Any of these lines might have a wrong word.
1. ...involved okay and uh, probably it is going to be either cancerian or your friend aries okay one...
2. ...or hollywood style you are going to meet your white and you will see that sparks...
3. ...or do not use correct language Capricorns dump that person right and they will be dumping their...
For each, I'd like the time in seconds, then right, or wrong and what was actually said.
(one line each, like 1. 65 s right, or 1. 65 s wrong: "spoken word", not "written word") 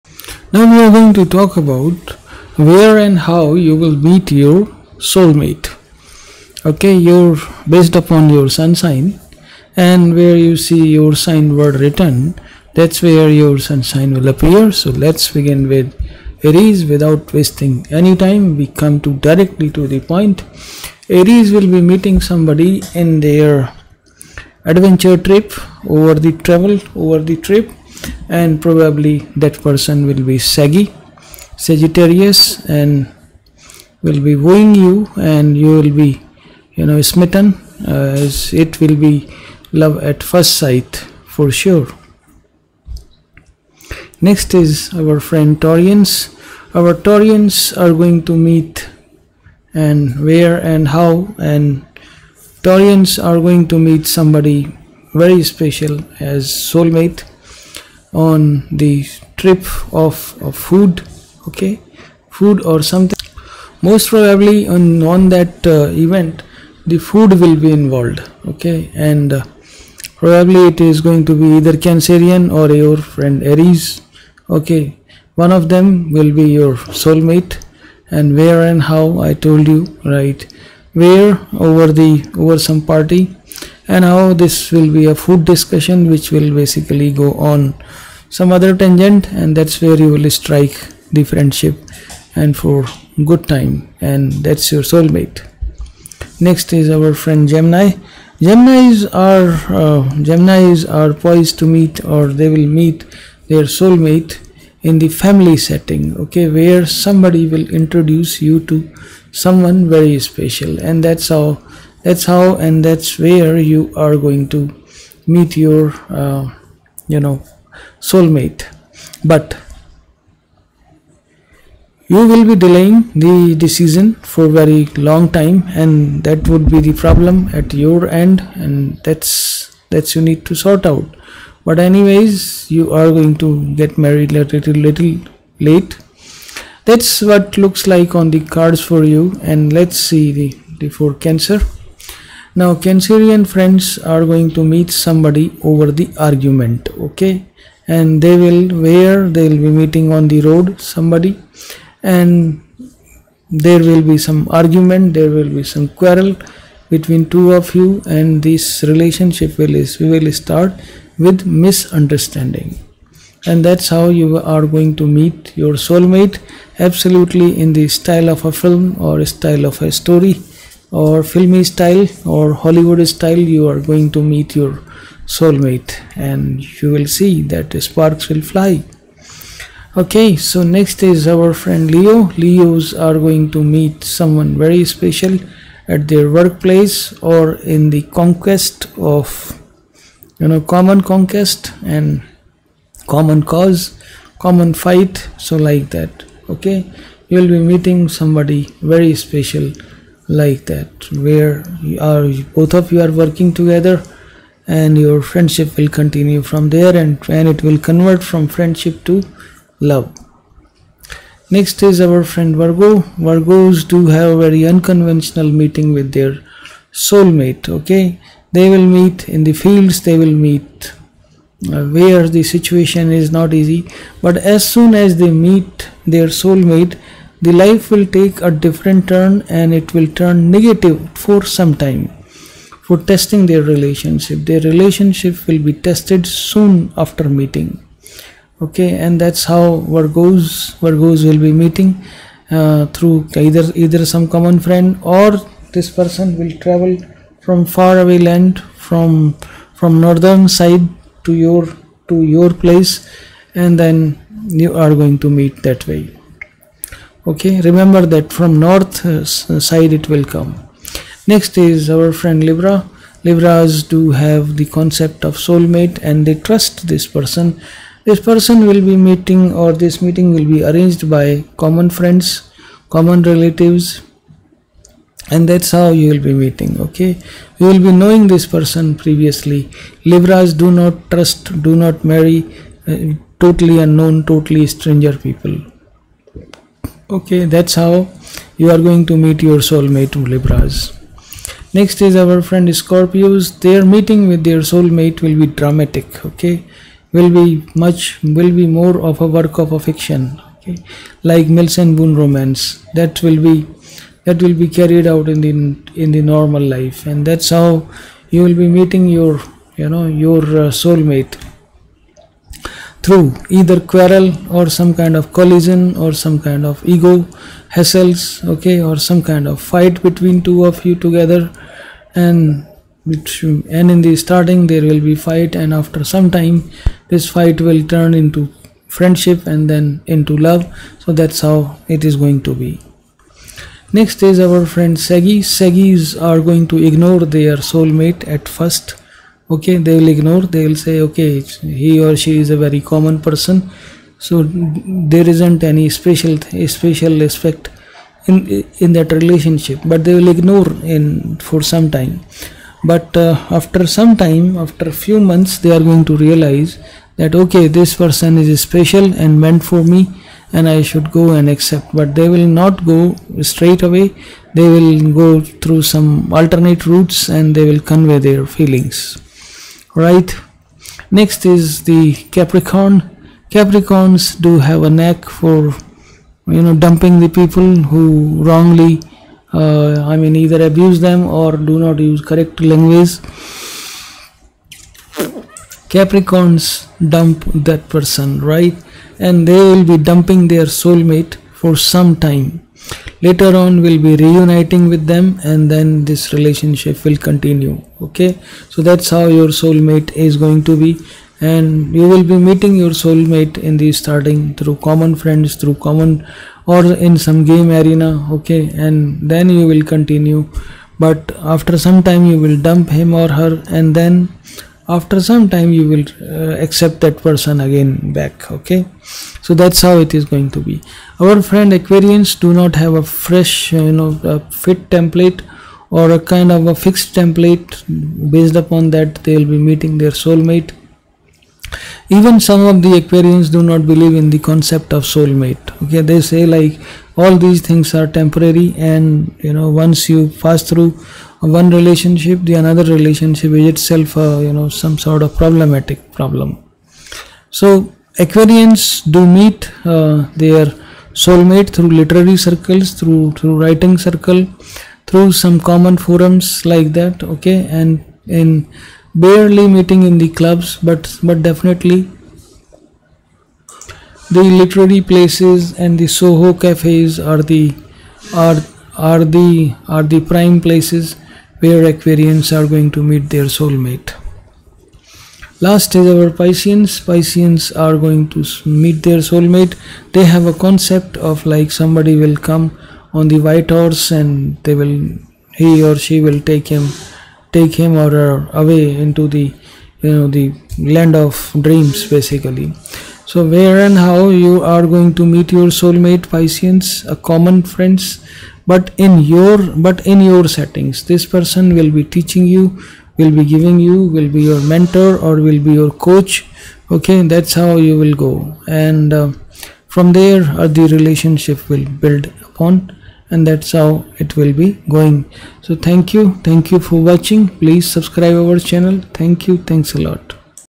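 1. 67 s right
2. 172 s wrong: "soulmate", not "white"
3. 381 s right.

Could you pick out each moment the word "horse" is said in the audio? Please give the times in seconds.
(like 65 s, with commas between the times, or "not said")
483 s.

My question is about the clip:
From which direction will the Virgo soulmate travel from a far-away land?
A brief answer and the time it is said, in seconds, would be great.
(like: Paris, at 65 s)
North, at 250 s.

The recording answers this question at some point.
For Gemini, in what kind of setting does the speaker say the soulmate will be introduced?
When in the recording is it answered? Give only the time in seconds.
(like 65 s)
105 s.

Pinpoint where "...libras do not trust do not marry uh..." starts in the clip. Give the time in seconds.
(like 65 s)
280 s.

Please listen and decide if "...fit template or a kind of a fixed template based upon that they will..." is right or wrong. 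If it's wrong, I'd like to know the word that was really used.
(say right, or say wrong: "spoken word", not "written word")
right.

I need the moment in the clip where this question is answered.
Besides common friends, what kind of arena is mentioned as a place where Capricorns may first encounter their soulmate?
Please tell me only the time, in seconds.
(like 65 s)
407 s.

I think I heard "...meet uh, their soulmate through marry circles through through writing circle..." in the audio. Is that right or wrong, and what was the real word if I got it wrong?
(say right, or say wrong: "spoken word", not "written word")
wrong: "literary", not "marry".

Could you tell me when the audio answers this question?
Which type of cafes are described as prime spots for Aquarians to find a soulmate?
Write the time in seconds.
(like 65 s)
466 s.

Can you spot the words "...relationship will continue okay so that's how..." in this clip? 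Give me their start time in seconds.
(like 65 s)
396 s.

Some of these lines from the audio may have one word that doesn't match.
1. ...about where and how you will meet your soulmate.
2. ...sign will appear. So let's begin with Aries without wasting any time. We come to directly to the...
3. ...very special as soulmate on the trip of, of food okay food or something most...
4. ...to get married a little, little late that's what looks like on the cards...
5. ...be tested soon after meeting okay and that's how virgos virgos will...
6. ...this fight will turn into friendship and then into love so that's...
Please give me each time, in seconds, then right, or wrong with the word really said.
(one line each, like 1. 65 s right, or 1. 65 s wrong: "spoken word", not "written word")
1. 1 s right
2. 13 s right
3. 55 s right
4. 133 s right
5. 235 s right
6. 327 s right.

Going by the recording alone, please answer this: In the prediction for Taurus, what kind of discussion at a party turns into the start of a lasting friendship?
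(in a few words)
Food discussion.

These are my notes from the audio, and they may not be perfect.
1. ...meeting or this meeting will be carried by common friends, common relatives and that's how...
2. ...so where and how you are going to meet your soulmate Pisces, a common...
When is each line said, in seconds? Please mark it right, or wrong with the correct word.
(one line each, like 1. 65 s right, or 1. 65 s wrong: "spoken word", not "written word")
1. 268 s wrong: "arranged", not "carried"
2. 493 s right.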